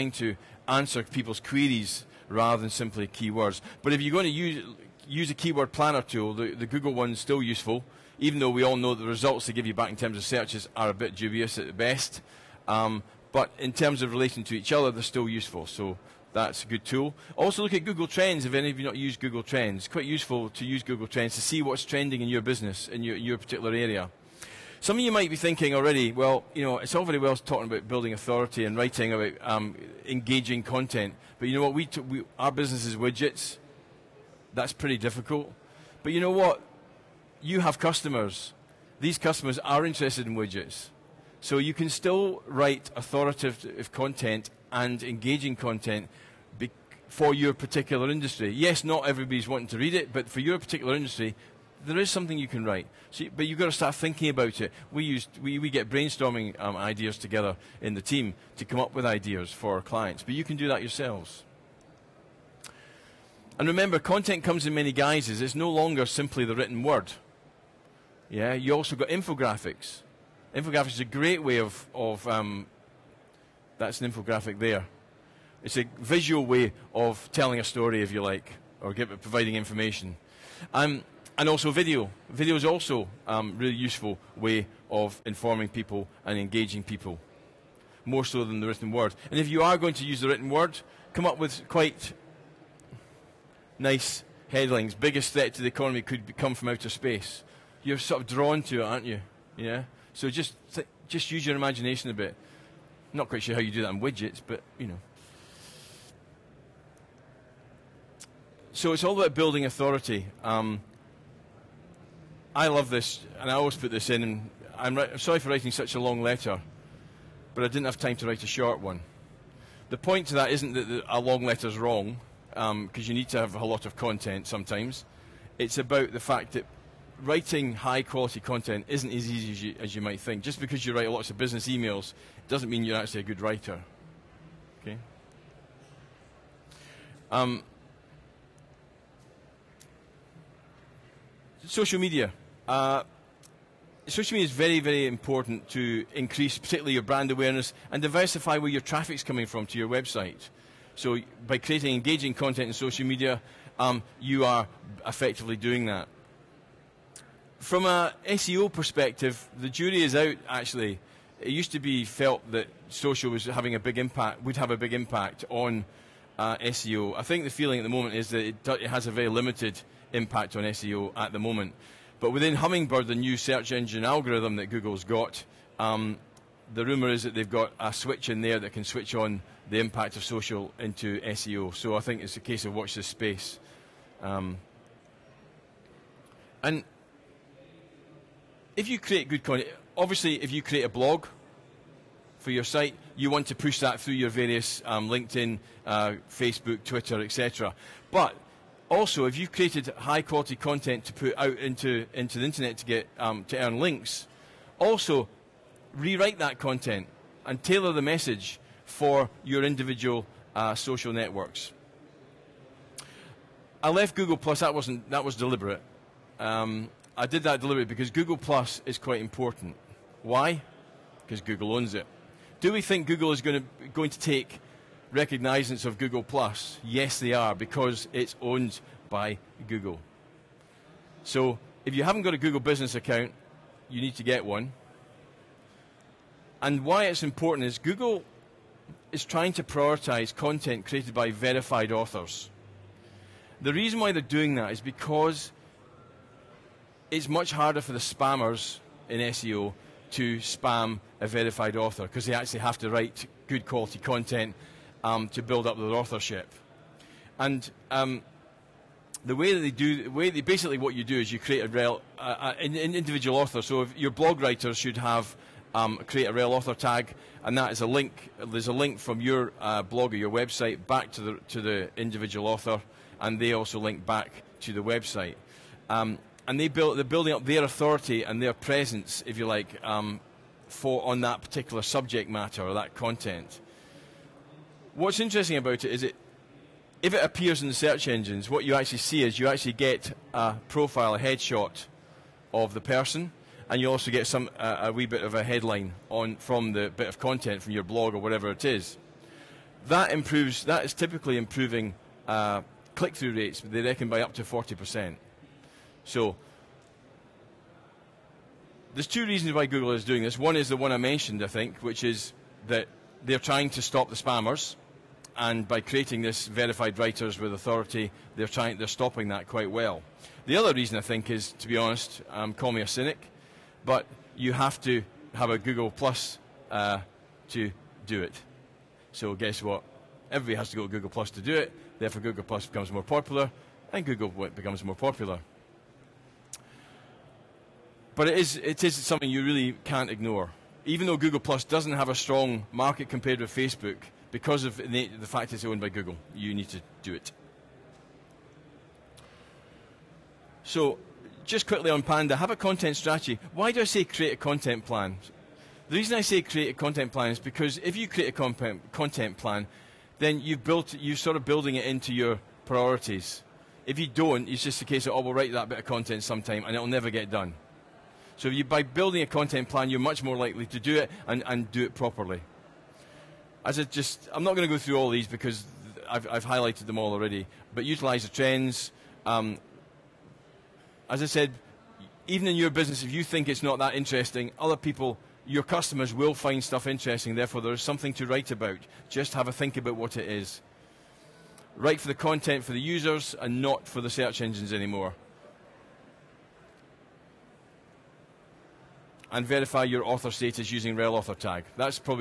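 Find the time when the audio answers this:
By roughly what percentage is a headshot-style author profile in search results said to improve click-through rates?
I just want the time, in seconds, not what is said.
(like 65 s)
304 s.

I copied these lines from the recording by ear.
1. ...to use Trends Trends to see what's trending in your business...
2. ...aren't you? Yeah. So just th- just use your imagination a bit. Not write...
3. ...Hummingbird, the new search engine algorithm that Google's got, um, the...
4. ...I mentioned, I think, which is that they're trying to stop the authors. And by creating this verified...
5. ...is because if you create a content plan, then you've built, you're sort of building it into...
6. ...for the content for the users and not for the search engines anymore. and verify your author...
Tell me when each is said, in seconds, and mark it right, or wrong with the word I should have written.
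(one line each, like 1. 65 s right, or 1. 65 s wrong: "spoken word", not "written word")
1. 20 s wrong: "Google", not "Trends"
2. 98 s wrong: "quite", not "write"
3. 172 s right
4. 310 s wrong: "spammers", not "authors"
5. 357 s right
6. 391 s right.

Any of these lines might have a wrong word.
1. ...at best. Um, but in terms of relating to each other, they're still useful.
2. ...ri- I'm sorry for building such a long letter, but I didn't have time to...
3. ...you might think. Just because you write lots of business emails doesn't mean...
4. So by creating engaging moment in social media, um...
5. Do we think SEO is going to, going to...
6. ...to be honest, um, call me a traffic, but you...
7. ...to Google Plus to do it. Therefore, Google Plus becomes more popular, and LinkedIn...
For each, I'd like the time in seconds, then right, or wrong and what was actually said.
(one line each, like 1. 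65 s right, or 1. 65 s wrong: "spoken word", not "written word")
1. 11 s right
2. 114 s wrong: "writing", not "building"
3. 129 s right
4. 150 s wrong: "content", not "moment"
5. 222 s wrong: "Google", not "SEO"
6. 321 s wrong: "cynic", not "traffic"
7. 330 s wrong: "Google", not "LinkedIn".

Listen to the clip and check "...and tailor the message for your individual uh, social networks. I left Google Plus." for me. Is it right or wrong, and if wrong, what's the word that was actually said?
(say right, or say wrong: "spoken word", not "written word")
right.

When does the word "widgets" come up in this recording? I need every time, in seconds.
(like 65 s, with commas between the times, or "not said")
32 s, 40 s, 104 s.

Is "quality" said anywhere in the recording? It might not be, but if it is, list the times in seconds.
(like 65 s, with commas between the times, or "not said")
128 s, 200 s, 253 s.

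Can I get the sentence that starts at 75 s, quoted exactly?
It's a visual way of telling a story, if you like, or give, providing information.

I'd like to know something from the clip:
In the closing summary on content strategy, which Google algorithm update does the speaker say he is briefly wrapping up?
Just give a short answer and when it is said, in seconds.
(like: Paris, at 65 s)
Panda, at 352 s.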